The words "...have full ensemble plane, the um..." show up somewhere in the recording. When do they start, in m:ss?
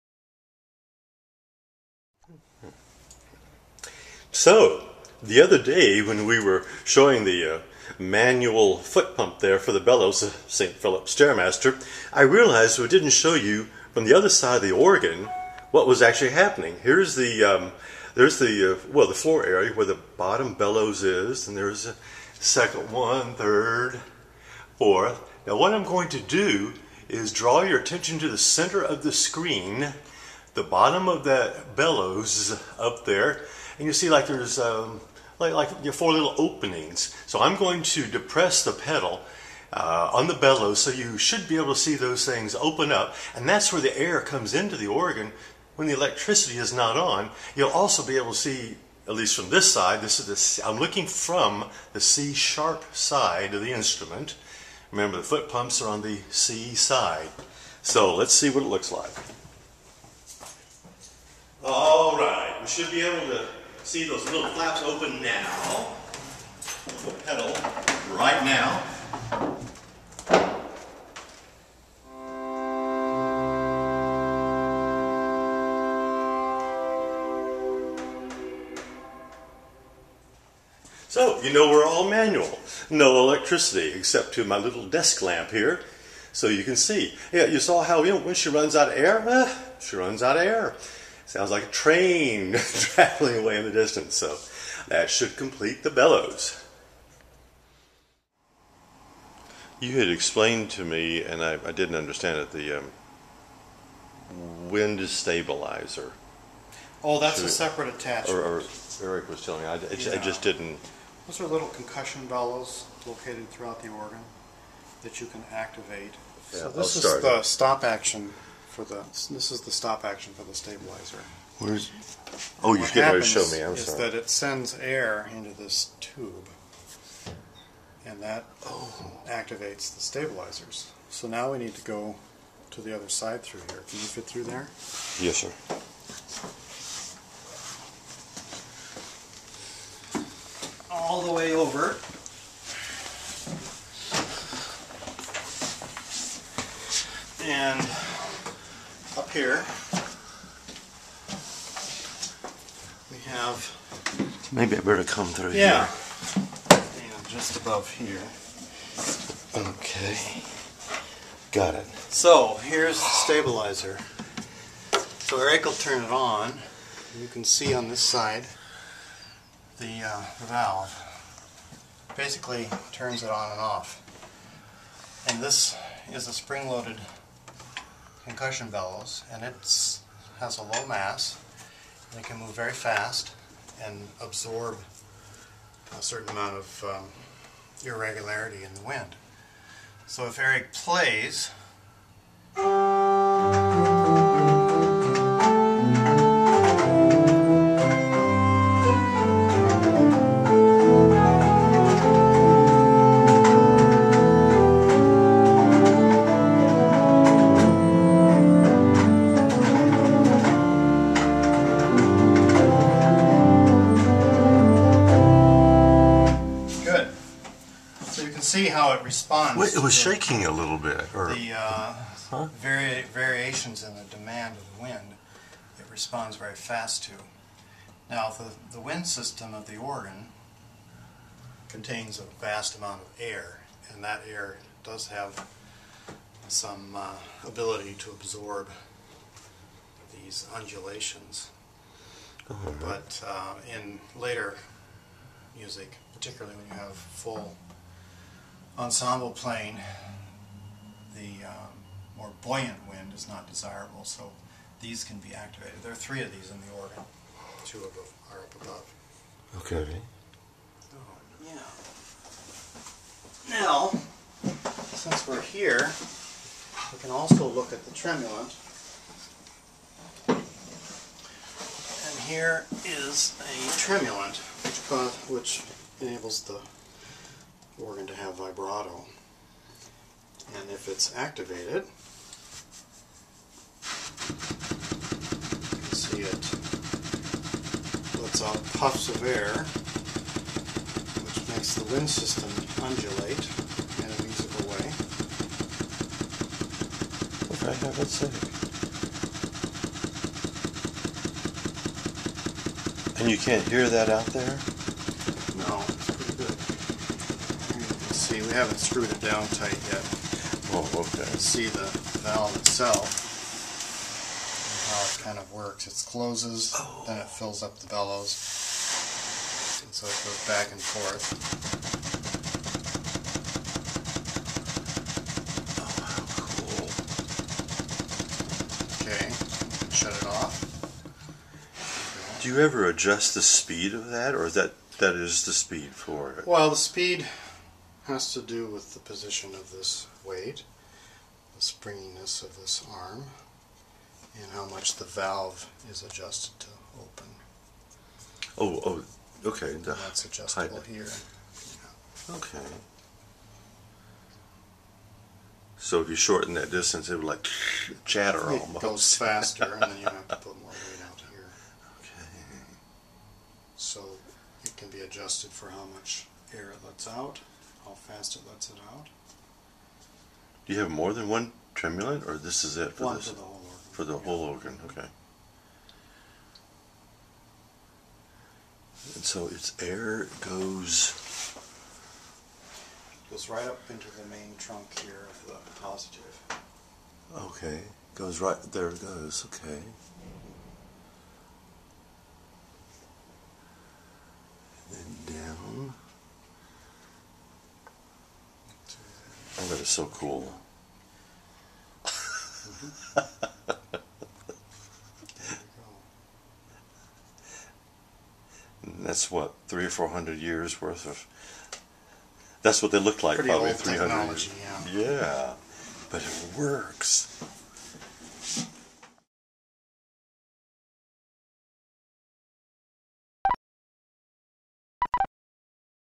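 4:06.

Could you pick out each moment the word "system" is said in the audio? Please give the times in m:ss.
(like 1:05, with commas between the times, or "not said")
3:49, 4:52.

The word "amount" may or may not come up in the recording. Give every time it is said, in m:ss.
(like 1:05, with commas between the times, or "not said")
3:06, 3:52.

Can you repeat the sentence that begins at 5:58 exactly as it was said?
It goes faster, and then you have to put more weight out here.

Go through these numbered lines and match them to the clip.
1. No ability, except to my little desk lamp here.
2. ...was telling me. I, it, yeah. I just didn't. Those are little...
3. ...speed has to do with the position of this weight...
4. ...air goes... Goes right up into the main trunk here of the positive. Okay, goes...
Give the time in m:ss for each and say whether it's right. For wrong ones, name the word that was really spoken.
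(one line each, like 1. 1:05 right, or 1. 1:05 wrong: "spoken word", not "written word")
1. 1:22 wrong: "electricity", not "ability"
2. 1:49 right
3. 5:36 right
4. 6:19 right.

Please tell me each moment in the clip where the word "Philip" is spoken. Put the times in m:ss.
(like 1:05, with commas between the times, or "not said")
0:10.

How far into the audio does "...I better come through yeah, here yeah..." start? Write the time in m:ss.
2:34.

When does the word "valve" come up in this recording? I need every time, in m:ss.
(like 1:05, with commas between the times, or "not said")
2:50, 5:12, 5:45.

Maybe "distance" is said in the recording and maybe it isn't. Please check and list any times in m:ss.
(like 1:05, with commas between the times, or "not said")
1:33, 5:56.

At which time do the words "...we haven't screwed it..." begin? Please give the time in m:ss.
5:08.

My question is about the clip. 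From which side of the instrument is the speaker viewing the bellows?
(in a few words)
C sharp side.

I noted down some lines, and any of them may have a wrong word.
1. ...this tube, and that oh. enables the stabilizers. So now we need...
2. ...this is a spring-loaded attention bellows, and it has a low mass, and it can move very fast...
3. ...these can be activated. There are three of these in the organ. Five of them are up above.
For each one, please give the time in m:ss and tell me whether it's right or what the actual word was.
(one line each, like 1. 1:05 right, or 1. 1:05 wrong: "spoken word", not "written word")
1. 2:05 wrong: "activates", not "enables"
2. 2:55 wrong: "concussion", not "attention"
3. 4:14 wrong: "Two", not "Five".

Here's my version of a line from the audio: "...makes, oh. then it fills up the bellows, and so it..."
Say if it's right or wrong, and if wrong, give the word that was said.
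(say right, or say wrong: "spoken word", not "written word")
wrong: "closes", not "makes".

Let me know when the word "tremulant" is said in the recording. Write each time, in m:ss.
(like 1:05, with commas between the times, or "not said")
4:27, 4:33, 6:11.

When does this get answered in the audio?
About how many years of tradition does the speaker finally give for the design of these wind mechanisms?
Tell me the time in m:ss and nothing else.
6:53.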